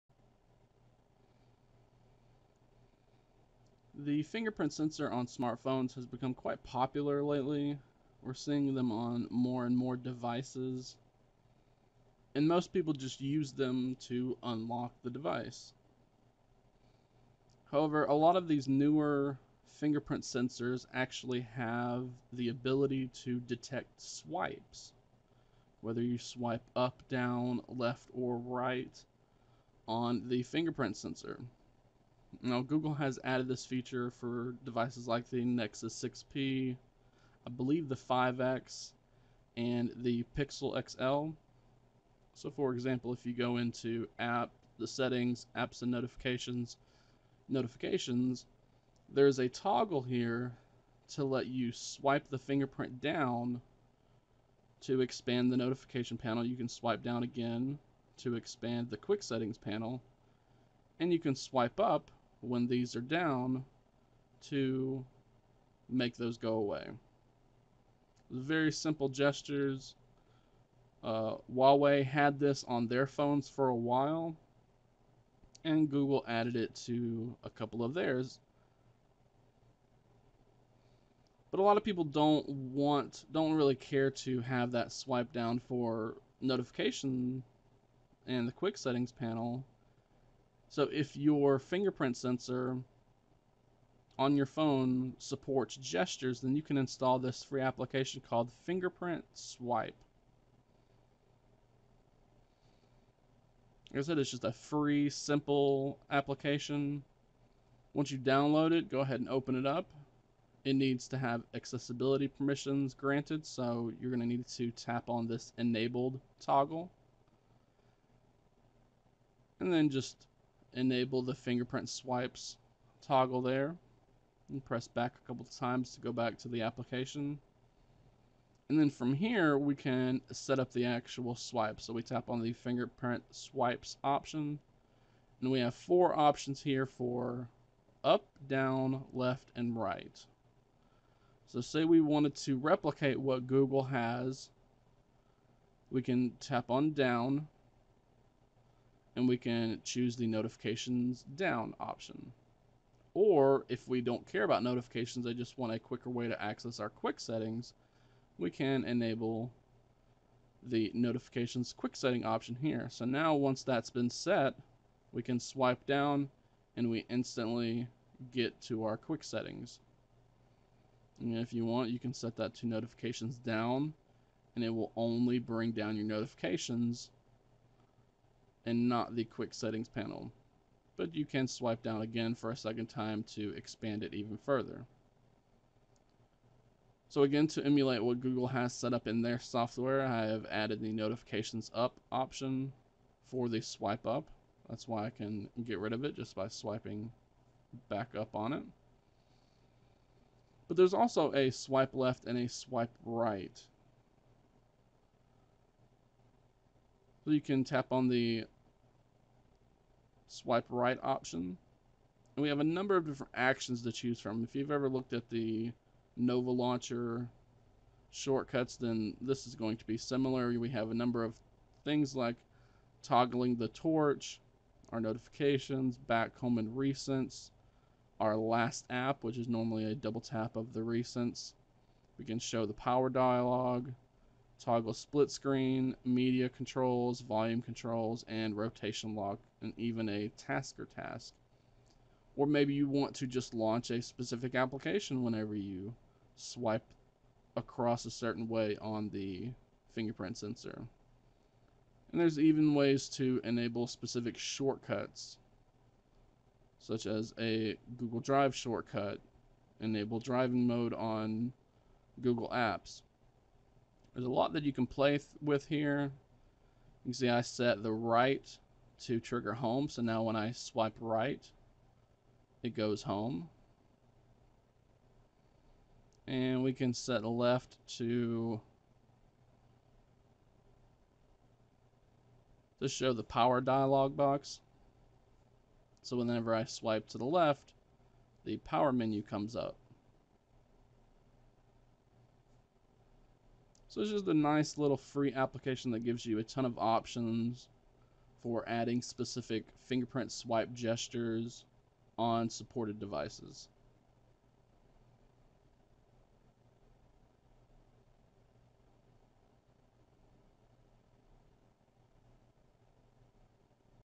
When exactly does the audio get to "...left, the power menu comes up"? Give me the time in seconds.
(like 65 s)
287 s.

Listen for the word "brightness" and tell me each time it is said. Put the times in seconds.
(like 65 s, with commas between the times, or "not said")
not said.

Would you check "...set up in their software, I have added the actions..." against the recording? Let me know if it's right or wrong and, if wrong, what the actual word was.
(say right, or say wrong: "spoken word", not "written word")
wrong: "notifications", not "actions".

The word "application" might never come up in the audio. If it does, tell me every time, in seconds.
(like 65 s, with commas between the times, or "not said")
97 s, 106 s, 126 s, 244 s, 295 s.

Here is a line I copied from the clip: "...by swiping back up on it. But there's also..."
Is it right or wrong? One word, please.
right.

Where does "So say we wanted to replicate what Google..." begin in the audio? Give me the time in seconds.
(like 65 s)
141 s.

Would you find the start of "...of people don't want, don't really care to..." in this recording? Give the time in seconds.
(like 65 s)
81 s.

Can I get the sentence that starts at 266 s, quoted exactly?
You can see I set the right to trigger home, so now when I swipe right, it goes home.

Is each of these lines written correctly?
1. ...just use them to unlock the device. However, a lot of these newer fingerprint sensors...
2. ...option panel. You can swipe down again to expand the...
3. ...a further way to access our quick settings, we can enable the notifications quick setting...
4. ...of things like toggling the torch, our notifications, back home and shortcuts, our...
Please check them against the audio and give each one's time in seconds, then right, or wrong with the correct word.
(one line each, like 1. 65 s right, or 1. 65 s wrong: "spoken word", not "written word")
1. 12 s right
2. 55 s wrong: "notification", not "option"
3. 155 s wrong: "quicker", not "further"
4. 221 s wrong: "recents", not "shortcuts".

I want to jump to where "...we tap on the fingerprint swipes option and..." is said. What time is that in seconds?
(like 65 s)
131 s.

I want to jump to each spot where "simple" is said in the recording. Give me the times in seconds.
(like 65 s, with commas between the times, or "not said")
68 s, 105 s.